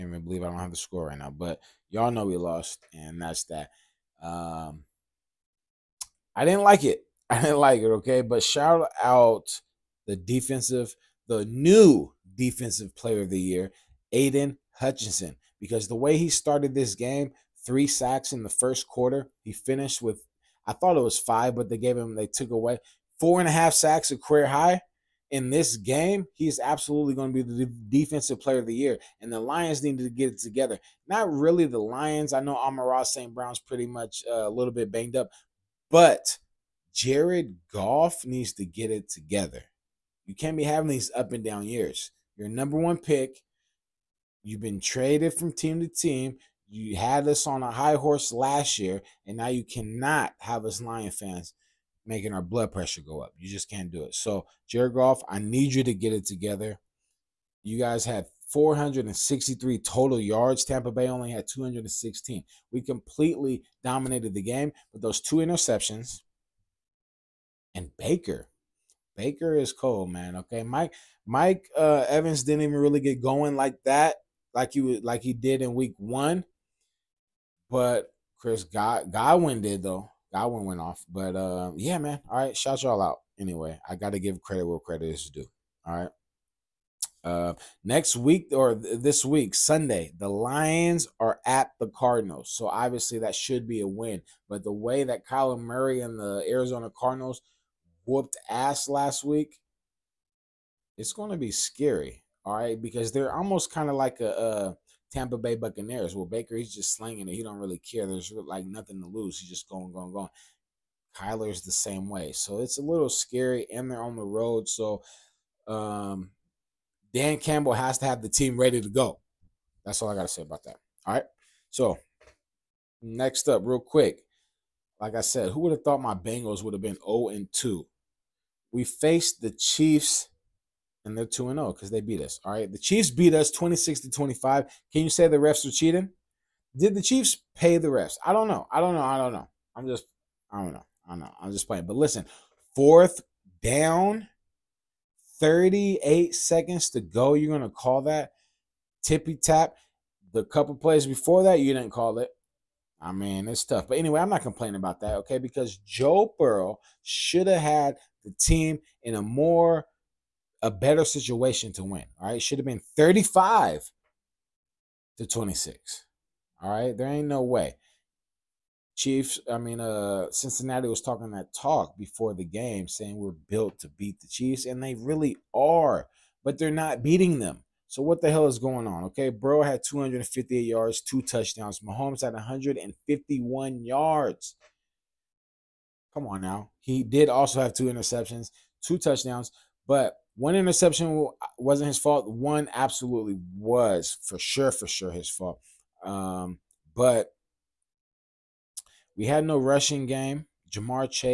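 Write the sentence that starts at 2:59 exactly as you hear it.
Okay, bro had 258 yards, two touchdowns.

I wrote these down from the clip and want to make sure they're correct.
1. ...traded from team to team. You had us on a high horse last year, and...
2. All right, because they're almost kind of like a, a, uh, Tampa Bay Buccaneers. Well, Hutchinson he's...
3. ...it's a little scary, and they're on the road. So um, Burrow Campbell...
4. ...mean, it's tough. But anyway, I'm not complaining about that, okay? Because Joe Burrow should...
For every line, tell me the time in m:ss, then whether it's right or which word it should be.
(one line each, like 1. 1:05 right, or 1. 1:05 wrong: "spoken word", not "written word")
1. 0:44 right
2. 1:42 wrong: "Baker", not "Hutchinson"
3. 1:52 wrong: "Dan", not "Burrow"
4. 2:33 right.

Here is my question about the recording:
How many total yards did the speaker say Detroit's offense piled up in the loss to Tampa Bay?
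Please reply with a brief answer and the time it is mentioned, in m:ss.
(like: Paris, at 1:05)
463, at 0:58.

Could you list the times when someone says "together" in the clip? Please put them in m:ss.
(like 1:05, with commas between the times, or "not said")
0:30, 0:39, 0:56.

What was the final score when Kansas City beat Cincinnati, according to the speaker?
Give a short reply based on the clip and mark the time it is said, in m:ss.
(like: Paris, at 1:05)
26-25, at 2:13.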